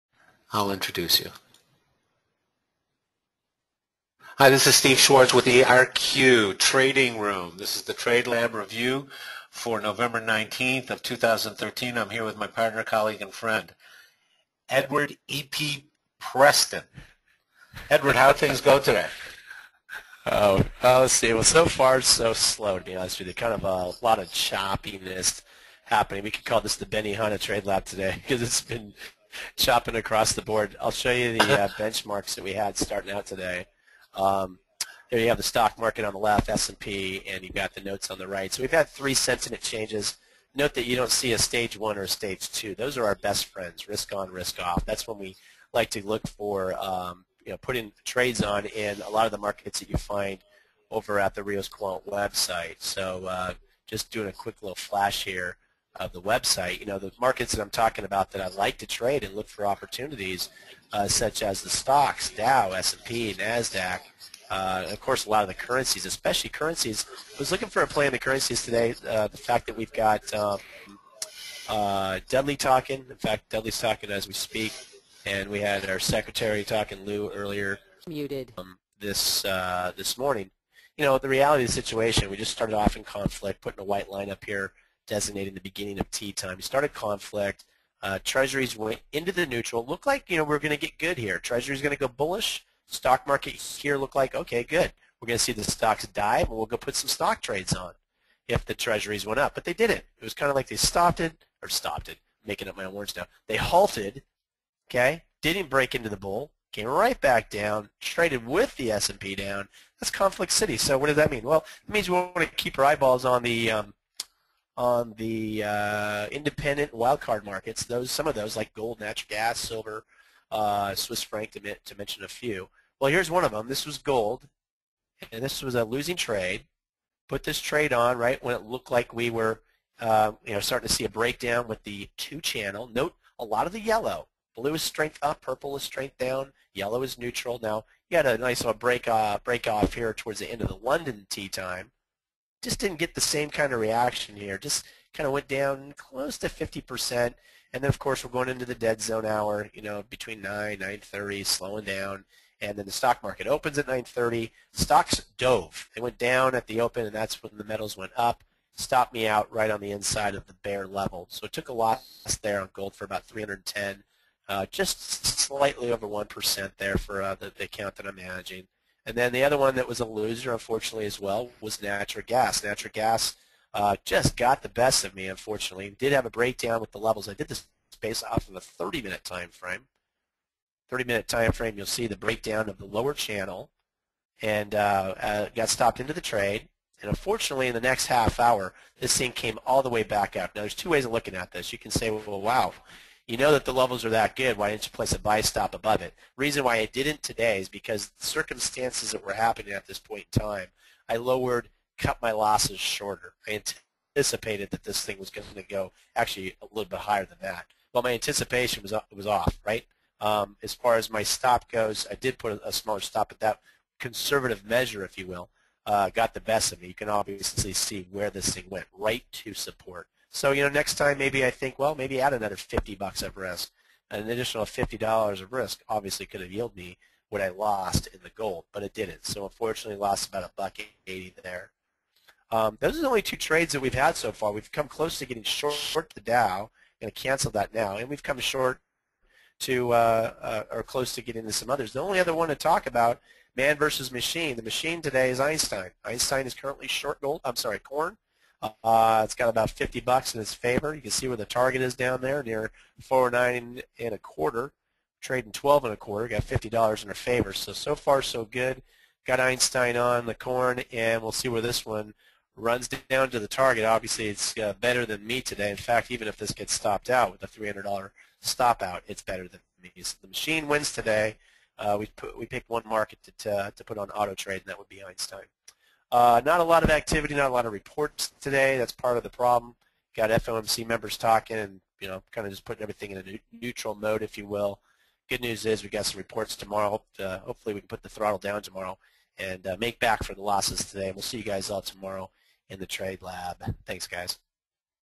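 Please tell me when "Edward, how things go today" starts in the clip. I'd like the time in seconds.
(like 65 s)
17 s.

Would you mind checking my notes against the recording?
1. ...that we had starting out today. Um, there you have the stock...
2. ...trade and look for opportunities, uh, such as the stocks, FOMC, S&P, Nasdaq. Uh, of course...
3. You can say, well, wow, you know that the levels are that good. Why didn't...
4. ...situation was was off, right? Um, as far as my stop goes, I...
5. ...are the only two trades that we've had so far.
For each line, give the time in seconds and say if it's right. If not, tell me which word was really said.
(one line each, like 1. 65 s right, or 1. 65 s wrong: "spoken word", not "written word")
1. 32 s right
2. 58 s wrong: "Dow", not "FOMC"
3. 191 s right
4. 208 s wrong: "anticipation", not "situation"
5. 232 s right.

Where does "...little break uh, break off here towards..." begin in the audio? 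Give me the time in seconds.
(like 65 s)
138 s.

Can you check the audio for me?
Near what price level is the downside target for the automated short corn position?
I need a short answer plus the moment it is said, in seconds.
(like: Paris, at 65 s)
409 1/4, at 253 s.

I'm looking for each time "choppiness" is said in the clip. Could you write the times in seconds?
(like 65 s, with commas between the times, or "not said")
24 s.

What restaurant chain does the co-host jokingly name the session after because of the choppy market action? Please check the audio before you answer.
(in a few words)
Benihana.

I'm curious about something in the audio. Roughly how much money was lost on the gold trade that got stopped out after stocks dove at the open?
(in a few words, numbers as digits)
$310.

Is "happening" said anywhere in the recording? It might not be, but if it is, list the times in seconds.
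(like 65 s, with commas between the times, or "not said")
25 s, 199 s.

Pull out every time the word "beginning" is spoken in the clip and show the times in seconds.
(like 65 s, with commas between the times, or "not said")
85 s.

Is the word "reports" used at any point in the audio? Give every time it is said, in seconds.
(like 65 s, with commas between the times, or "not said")
277 s, 286 s.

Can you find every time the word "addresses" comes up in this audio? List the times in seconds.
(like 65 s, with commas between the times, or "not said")
not said.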